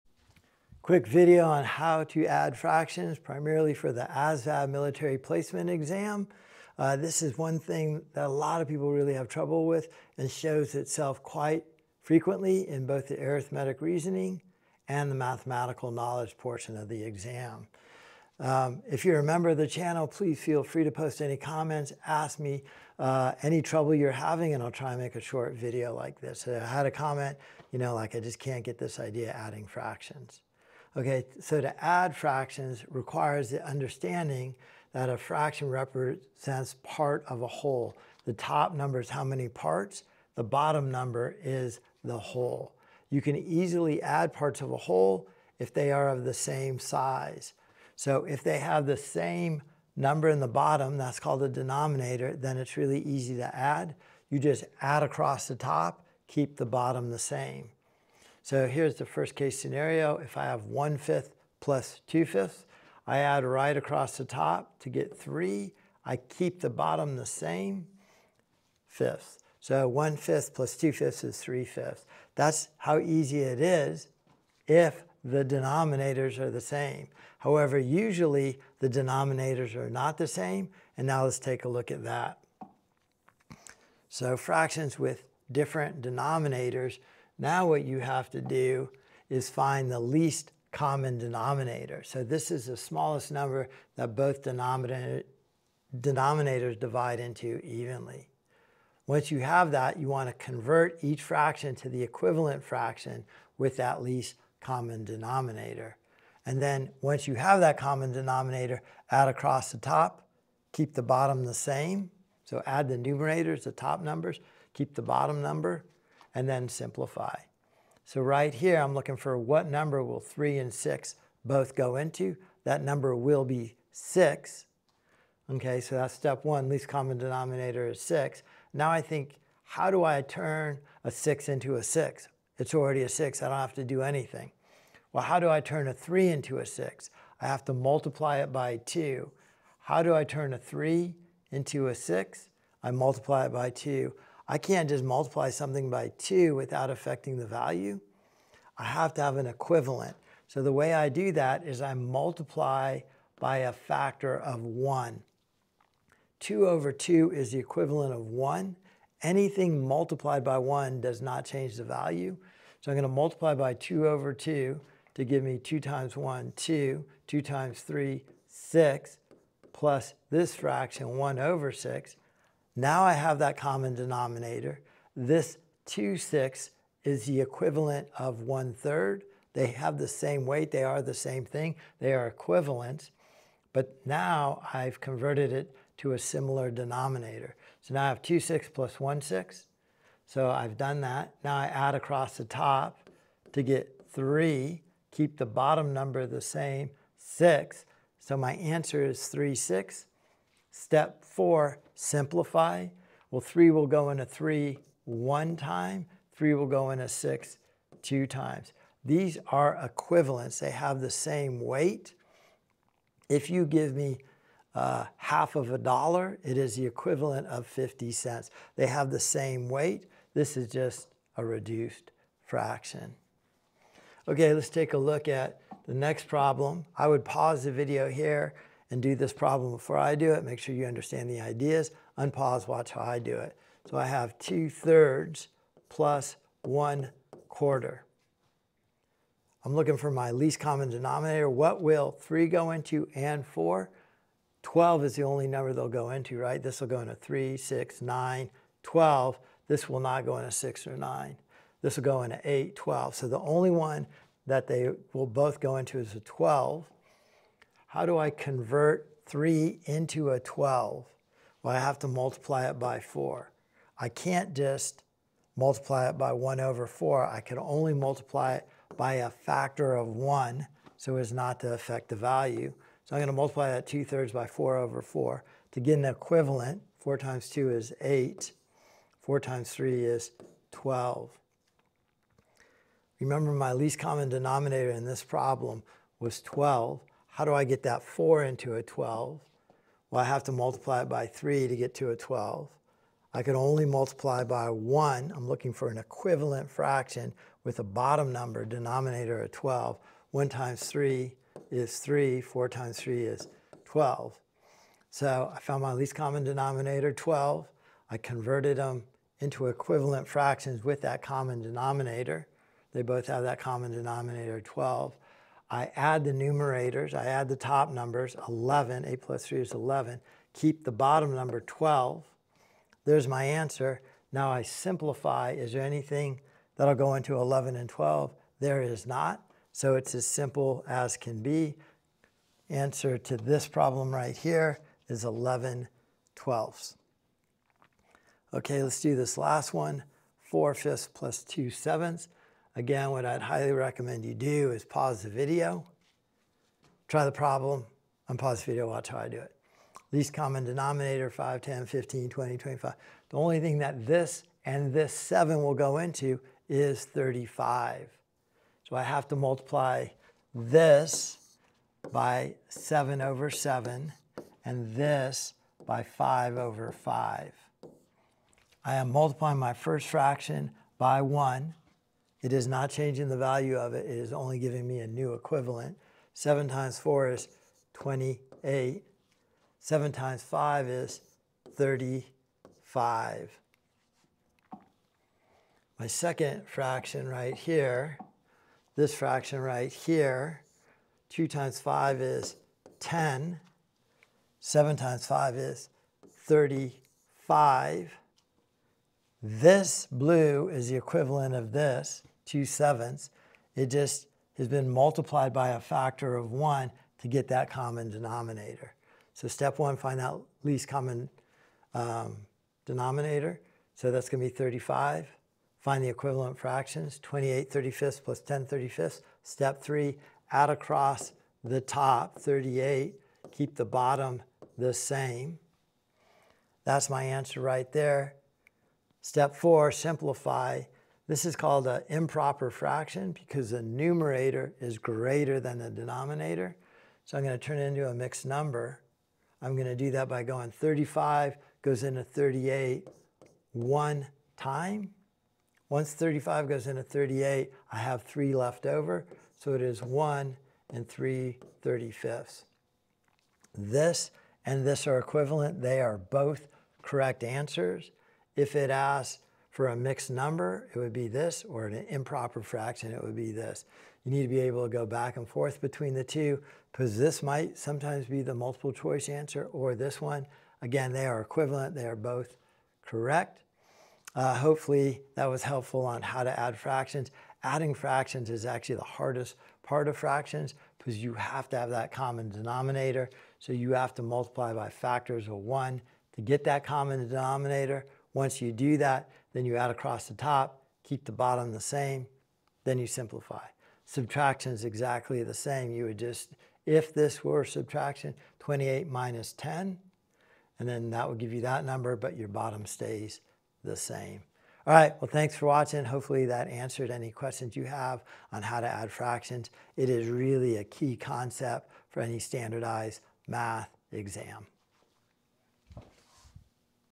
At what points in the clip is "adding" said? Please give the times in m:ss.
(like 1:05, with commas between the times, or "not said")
0:29, 7:57.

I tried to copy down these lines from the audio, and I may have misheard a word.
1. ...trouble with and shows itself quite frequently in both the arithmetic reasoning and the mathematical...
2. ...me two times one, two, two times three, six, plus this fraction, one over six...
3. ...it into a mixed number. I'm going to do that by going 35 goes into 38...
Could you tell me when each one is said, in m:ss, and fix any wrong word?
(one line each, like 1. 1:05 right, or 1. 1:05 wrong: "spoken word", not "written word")
1. 0:09 right
2. 2:45 right
3. 7:17 right.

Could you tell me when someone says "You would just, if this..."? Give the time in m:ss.
8:15.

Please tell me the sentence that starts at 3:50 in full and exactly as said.
Make sure you understand the ideas.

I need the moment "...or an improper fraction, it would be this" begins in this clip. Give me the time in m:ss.
7:41.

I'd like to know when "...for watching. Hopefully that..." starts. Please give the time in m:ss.
8:25.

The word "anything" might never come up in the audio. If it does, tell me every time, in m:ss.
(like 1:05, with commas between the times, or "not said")
2:14, 2:39, 5:25.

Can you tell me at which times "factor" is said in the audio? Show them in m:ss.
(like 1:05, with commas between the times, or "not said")
2:33, 4:29, 6:45, 8:04.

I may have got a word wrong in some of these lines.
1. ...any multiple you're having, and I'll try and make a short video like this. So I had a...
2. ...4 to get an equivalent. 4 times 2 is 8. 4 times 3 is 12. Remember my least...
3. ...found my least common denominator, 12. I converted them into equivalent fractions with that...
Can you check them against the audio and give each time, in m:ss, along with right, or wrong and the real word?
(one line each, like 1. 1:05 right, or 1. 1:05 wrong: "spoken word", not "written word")
1. 0:23 wrong: "trouble", not "multiple"
2. 4:35 right
3. 5:05 right.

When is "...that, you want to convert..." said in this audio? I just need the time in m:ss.
1:39.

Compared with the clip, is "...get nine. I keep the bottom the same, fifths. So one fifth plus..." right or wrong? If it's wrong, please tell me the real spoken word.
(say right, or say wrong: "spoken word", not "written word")
wrong: "three", not "nine".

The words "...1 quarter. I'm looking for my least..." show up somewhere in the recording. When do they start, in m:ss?
3:56.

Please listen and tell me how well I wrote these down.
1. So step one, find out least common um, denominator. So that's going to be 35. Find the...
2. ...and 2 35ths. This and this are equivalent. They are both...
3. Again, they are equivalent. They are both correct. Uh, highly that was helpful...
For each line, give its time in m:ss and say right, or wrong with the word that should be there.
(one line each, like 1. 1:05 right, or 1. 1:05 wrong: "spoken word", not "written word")
1. 6:49 right
2. 7:30 wrong: "3", not "2"
3. 7:50 wrong: "hopefully", not "highly".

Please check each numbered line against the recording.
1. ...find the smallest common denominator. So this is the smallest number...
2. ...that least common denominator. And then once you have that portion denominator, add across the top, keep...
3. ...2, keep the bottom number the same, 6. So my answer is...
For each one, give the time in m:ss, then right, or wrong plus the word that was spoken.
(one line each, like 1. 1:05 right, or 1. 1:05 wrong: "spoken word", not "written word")
1. 1:29 wrong: "least", not "smallest"
2. 1:43 wrong: "common", not "portion"
3. 3:14 wrong: "3", not "2".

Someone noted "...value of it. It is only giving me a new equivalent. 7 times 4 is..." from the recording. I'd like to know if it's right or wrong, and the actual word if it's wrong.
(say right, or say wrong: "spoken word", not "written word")
right.